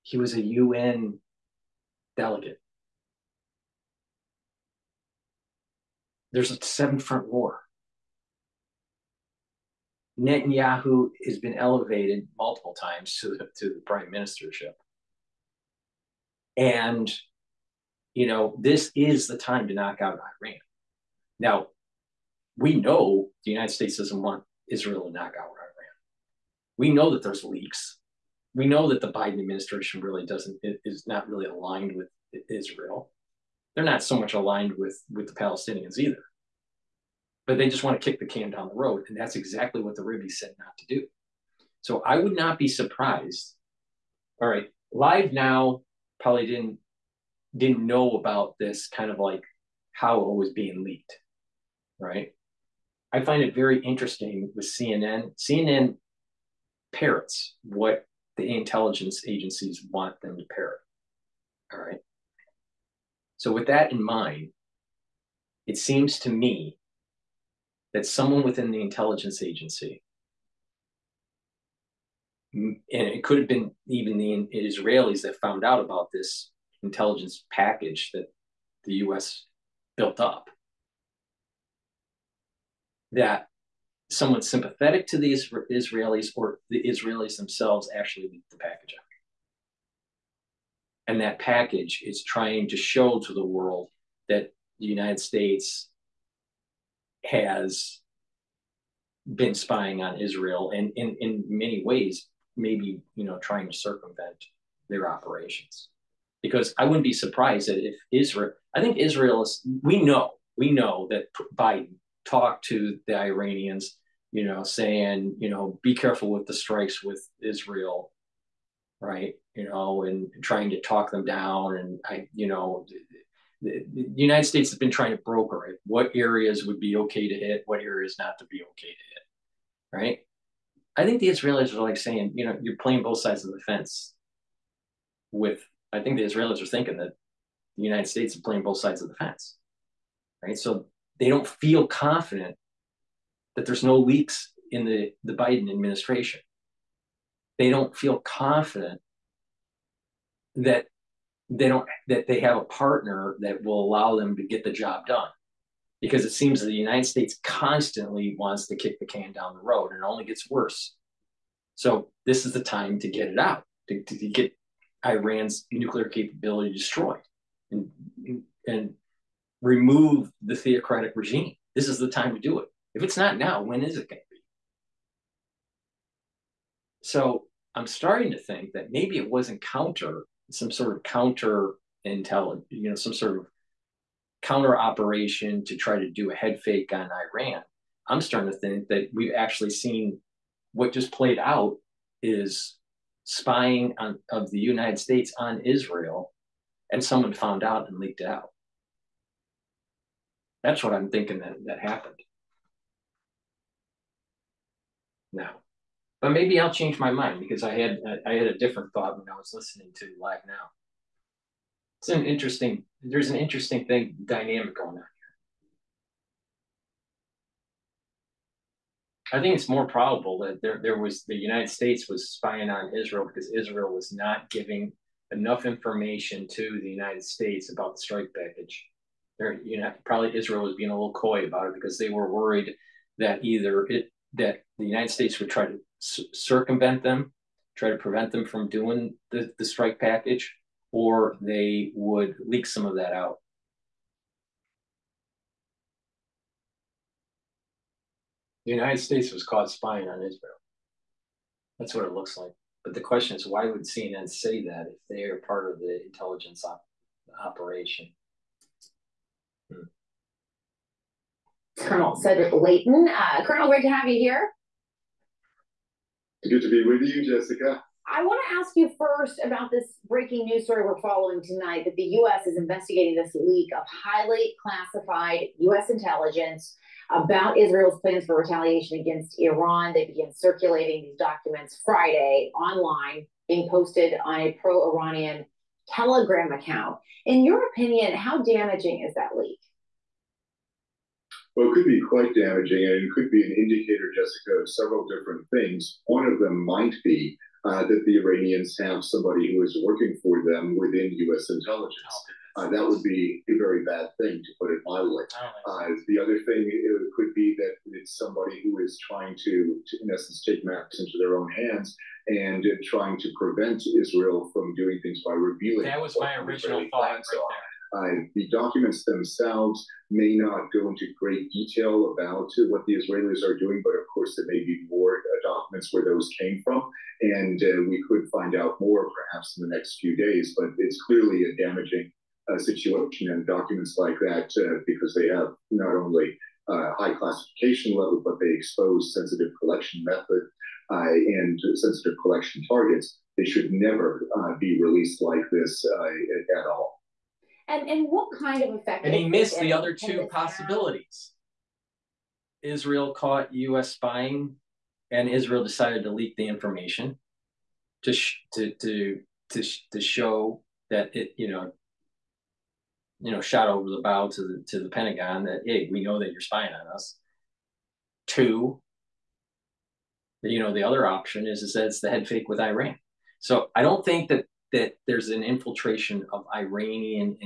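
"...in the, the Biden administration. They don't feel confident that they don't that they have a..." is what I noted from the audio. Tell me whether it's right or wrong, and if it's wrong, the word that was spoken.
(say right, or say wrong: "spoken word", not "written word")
right.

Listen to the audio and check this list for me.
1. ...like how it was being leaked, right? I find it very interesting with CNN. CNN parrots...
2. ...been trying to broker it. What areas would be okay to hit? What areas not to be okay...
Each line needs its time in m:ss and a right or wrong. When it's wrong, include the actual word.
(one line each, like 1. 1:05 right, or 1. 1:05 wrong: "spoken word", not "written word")
1. 0:49 right
2. 2:04 right.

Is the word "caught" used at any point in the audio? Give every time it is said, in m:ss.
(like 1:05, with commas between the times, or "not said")
4:09, 5:53.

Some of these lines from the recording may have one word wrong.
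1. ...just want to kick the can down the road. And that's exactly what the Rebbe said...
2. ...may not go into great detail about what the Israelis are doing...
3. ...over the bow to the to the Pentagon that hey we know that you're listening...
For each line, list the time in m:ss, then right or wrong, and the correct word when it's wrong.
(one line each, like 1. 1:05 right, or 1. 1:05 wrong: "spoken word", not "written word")
1. 0:37 right
2. 5:20 right
3. 6:03 wrong: "spying", not "listening".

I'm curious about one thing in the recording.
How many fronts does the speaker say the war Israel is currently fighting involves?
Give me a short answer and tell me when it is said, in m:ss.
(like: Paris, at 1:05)
7, at 0:06.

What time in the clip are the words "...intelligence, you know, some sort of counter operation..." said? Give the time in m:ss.
3:02.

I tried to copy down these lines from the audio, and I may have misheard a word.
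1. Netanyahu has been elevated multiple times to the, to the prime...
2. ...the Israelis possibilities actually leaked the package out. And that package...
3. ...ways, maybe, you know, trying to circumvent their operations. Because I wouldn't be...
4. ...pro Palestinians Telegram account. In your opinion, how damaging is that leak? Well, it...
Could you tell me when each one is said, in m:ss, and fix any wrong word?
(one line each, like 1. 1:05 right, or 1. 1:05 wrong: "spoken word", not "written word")
1. 0:10 right
2. 1:26 wrong: "themselves", not "possibilities"
3. 1:41 right
4. 4:44 wrong: "Iranian", not "Palestinians".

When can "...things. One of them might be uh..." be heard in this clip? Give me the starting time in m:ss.
4:55.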